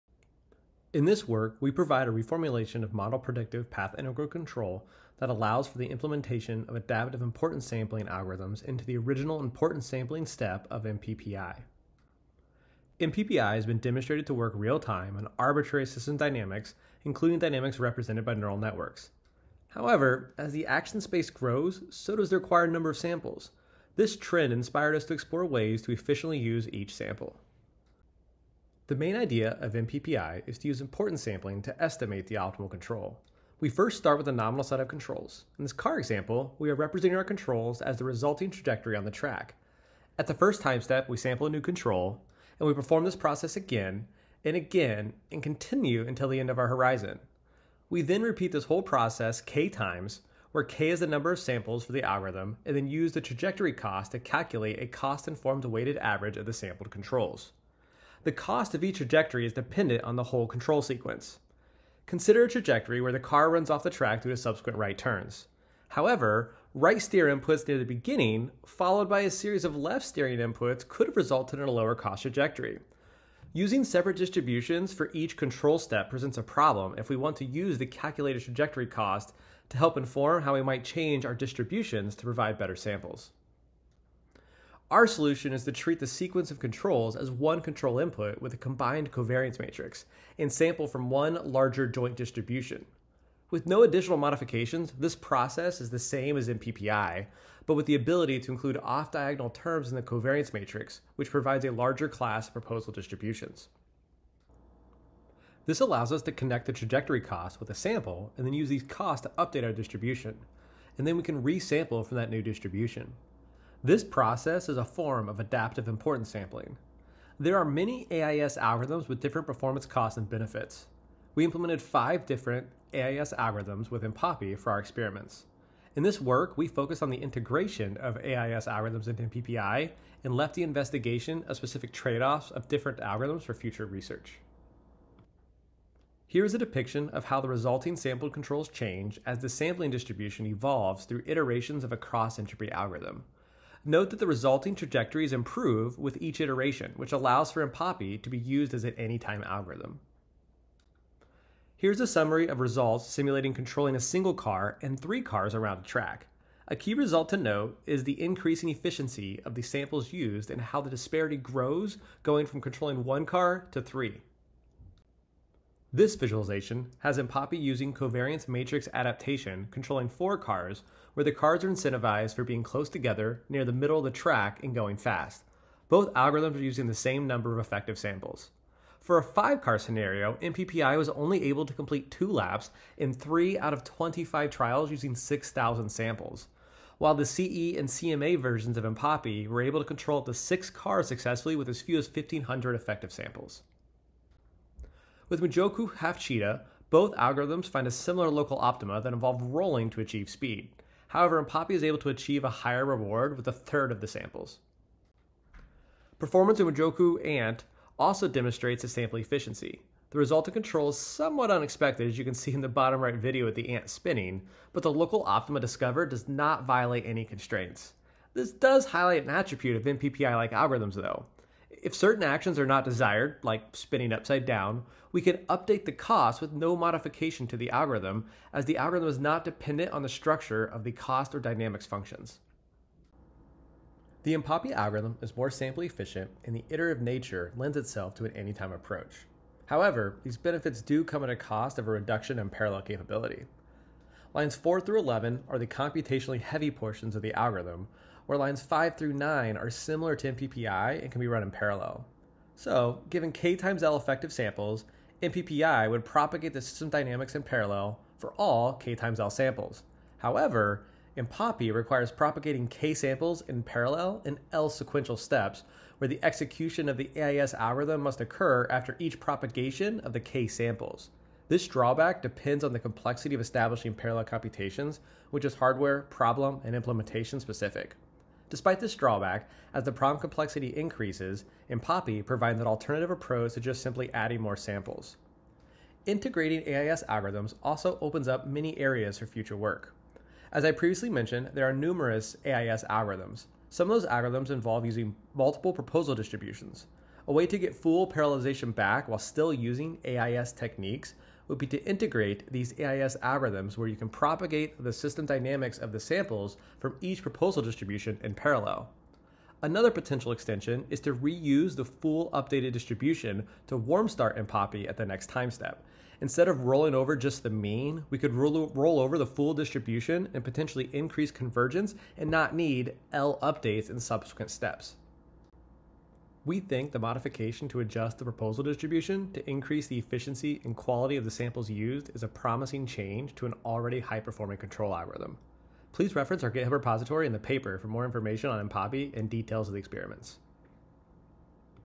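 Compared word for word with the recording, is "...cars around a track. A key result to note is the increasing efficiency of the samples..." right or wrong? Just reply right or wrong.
right.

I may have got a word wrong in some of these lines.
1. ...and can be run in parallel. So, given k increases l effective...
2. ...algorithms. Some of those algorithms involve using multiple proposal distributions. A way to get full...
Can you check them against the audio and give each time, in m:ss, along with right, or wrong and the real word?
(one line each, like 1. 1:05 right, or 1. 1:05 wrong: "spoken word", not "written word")
1. 4:11 wrong: "times", not "increases"
2. 4:52 right.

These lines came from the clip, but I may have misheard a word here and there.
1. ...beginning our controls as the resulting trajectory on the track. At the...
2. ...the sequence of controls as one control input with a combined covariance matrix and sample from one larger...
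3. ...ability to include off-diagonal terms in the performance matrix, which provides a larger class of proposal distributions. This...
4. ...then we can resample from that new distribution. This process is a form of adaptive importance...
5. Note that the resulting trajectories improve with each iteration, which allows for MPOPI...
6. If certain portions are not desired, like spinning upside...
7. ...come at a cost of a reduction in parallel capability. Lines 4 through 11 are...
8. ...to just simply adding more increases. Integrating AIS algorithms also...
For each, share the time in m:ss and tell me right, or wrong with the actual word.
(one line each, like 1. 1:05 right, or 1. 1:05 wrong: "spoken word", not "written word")
1. 0:36 wrong: "representing", not "beginning"
2. 1:25 right
3. 1:37 wrong: "covariance", not "performance"
4. 1:51 right
5. 2:23 right
6. 3:41 wrong: "actions", not "portions"
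7. 4:01 right
8. 4:43 wrong: "samples", not "increases".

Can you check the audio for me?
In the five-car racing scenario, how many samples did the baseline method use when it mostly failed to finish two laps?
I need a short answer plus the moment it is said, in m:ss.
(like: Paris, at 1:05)
6,000, at 3:05.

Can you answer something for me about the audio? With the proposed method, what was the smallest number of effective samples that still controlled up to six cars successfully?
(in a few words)
1,500.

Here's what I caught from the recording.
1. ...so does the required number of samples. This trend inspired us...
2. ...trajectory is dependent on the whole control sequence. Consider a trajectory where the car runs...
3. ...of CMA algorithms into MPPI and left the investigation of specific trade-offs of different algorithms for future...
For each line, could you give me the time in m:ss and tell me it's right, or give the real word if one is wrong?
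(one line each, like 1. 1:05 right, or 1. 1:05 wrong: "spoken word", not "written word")
1. 0:21 right
2. 0:58 right
3. 2:07 wrong: "AIS", not "CMA".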